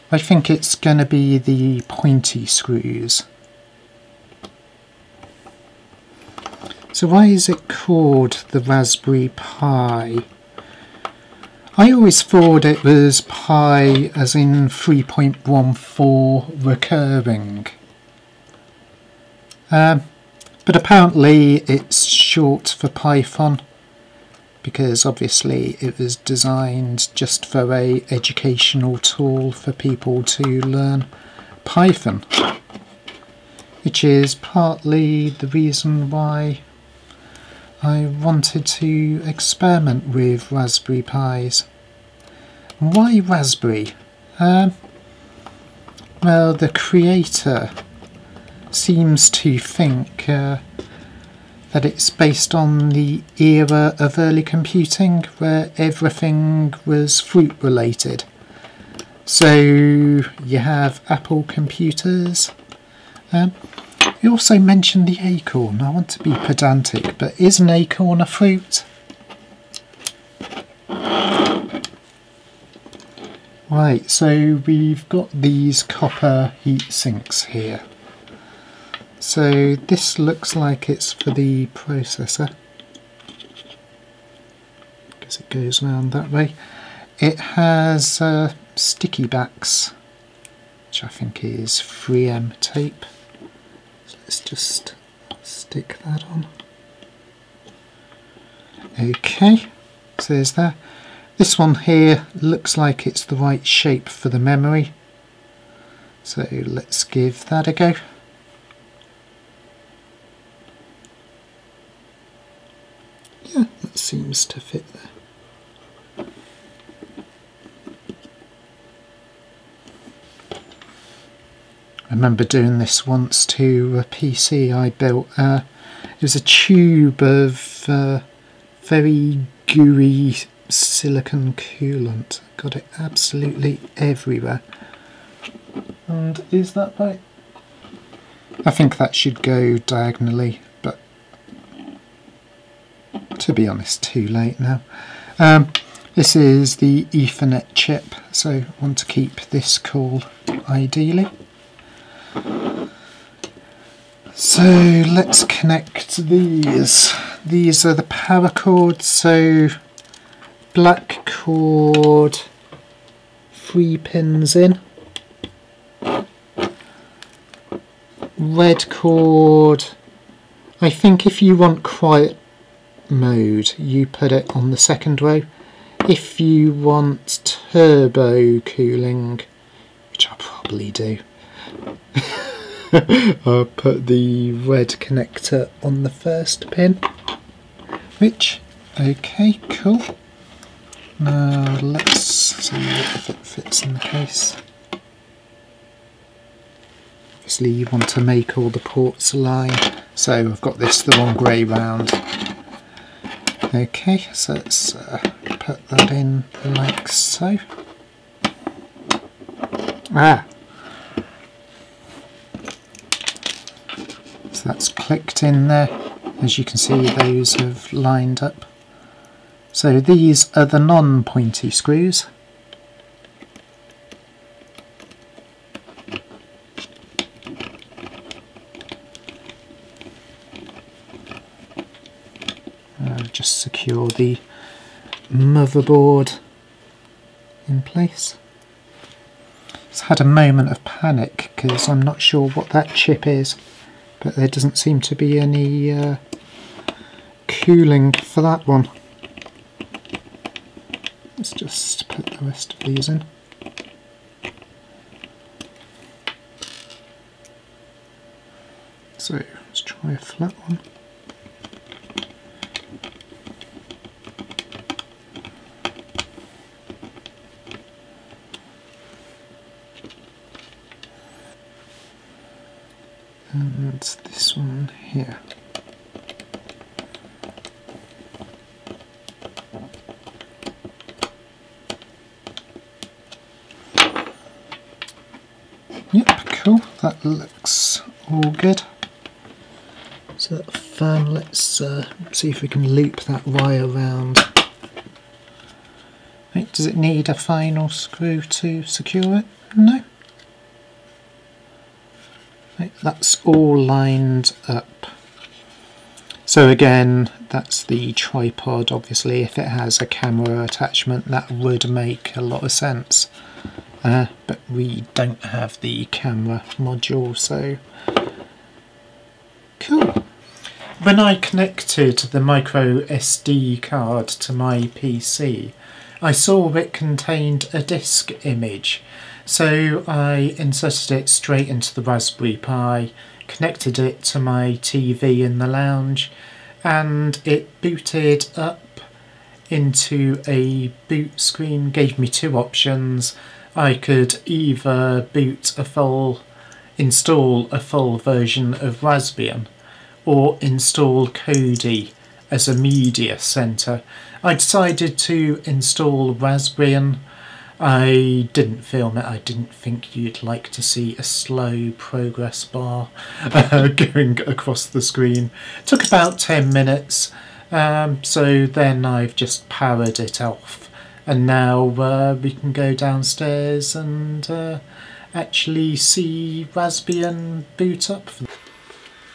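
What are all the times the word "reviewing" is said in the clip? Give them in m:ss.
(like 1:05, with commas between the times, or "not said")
not said.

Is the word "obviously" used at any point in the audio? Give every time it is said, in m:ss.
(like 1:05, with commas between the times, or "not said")
0:25, 3:17, 5:08.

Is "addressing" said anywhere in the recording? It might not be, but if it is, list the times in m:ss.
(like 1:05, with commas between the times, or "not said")
not said.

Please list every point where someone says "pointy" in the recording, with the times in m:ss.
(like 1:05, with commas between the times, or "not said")
0:01, 3:40.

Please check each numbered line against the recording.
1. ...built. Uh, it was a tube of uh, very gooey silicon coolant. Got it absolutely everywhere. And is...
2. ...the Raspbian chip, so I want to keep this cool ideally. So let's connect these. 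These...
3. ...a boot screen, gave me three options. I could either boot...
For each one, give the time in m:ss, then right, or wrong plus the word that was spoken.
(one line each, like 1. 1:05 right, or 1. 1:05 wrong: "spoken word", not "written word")
1. 2:04 right
2. 2:26 wrong: "Ethernet", not "Raspbian"
3. 5:40 wrong: "two", not "three".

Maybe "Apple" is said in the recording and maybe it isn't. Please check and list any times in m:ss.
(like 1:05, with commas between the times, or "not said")
1:01.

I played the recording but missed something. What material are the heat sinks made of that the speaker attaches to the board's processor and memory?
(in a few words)
Copper.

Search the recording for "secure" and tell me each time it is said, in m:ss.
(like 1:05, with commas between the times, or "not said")
3:53, 4:58.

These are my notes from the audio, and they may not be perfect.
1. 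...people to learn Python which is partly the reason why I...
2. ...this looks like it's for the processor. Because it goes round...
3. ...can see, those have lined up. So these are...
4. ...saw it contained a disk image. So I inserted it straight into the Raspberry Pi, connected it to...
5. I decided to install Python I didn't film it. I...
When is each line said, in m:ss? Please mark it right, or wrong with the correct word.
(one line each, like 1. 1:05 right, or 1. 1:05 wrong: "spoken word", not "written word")
1. 0:29 right
2. 1:19 right
3. 3:36 right
4. 5:26 right
5. 5:54 wrong: "Raspbian", not "Python".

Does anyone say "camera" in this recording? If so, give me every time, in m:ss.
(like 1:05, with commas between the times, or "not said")
5:10, 5:16.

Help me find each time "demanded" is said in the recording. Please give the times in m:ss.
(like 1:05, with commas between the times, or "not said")
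not said.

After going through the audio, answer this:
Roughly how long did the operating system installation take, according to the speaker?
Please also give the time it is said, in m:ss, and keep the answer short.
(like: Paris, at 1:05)
10 minutes, at 6:06.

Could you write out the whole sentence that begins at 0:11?
I always thought it was pi as in 3.14 recurring.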